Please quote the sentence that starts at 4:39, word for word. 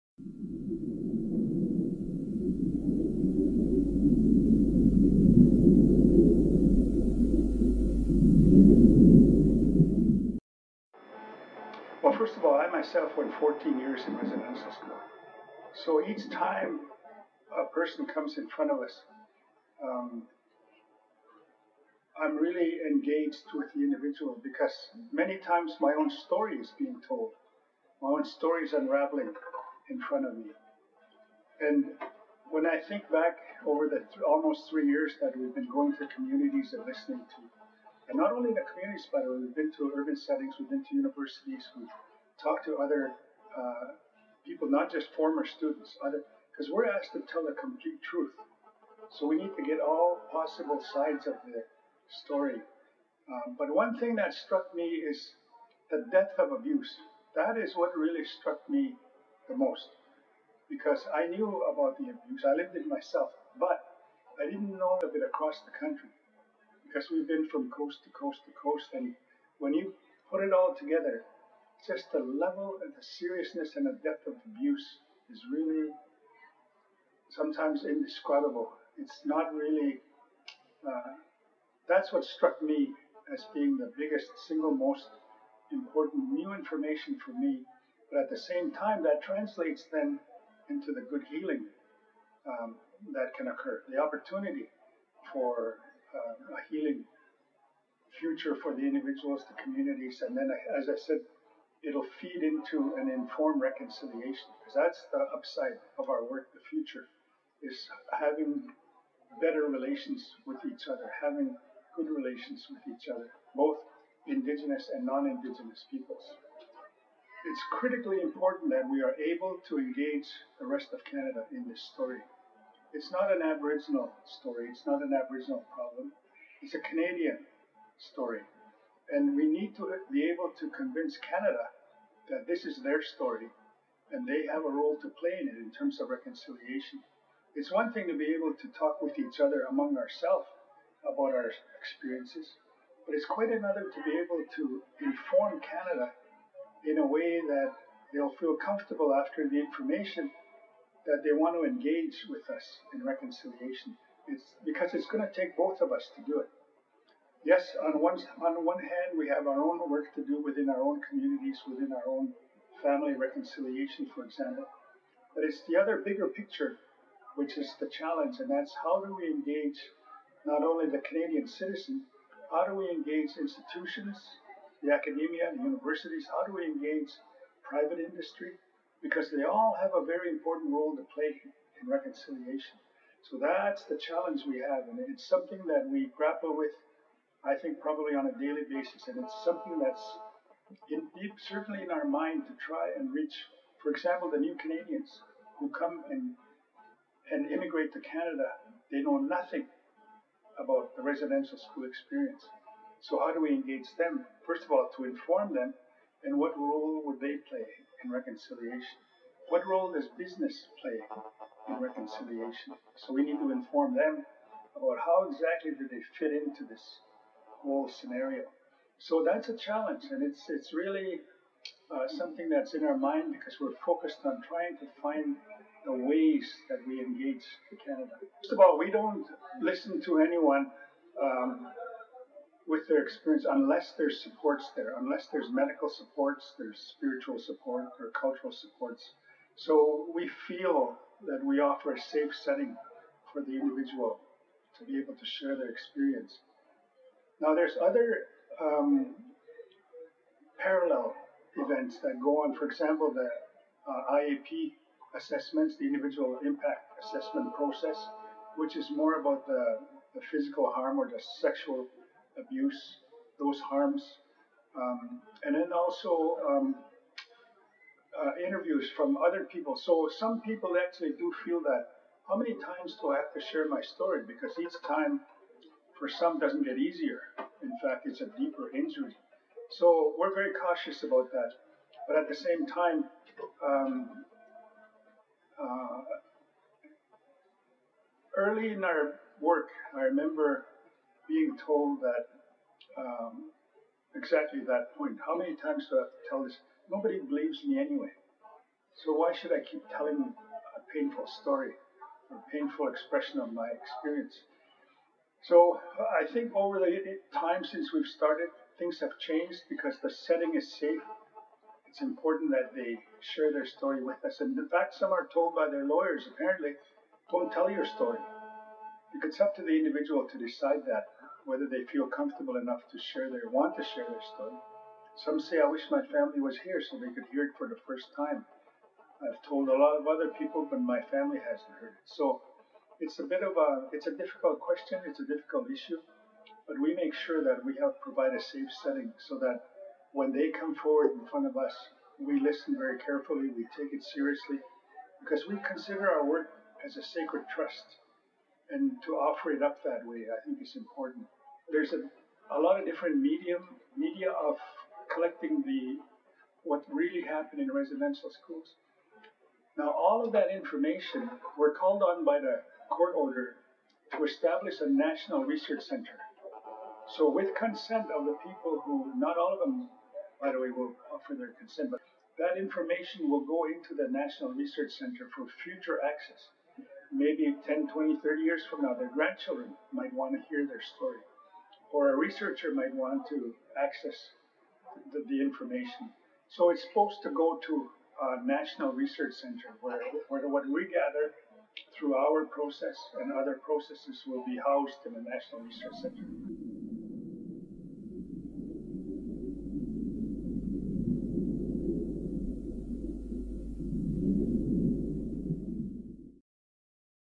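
So we're very cautious about that.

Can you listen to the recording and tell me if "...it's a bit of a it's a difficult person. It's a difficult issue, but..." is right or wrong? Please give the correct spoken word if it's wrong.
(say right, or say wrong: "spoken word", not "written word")
wrong: "question", not "person".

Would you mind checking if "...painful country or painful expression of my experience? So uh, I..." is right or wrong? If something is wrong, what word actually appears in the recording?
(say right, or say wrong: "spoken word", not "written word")
wrong: "story", not "country".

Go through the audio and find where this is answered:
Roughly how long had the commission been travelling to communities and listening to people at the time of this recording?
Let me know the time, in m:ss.
0:34.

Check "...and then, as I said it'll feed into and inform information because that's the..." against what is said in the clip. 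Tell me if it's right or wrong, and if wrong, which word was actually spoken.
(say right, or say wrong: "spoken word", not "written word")
wrong: "reconciliation", not "information".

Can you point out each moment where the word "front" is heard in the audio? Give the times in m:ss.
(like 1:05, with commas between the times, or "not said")
0:18, 0:30, 5:41.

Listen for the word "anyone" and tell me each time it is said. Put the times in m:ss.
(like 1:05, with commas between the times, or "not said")
3:50.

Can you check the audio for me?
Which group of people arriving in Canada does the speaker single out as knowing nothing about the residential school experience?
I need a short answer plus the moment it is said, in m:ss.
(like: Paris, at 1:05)
new Canadians, at 3:14.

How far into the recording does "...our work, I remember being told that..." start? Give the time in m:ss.
4:48.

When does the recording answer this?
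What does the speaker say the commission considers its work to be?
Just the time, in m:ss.
5:46.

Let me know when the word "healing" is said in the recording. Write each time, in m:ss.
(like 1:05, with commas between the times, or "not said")
1:31, 1:36.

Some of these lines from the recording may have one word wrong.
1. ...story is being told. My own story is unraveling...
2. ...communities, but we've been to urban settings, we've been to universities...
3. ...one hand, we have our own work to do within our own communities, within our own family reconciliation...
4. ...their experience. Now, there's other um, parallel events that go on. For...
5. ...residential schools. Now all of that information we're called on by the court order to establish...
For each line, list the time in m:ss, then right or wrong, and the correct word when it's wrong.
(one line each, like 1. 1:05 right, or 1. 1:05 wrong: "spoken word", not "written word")
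1. 0:26 right
2. 0:38 right
3. 2:38 right
4. 4:05 right
5. 5:57 right.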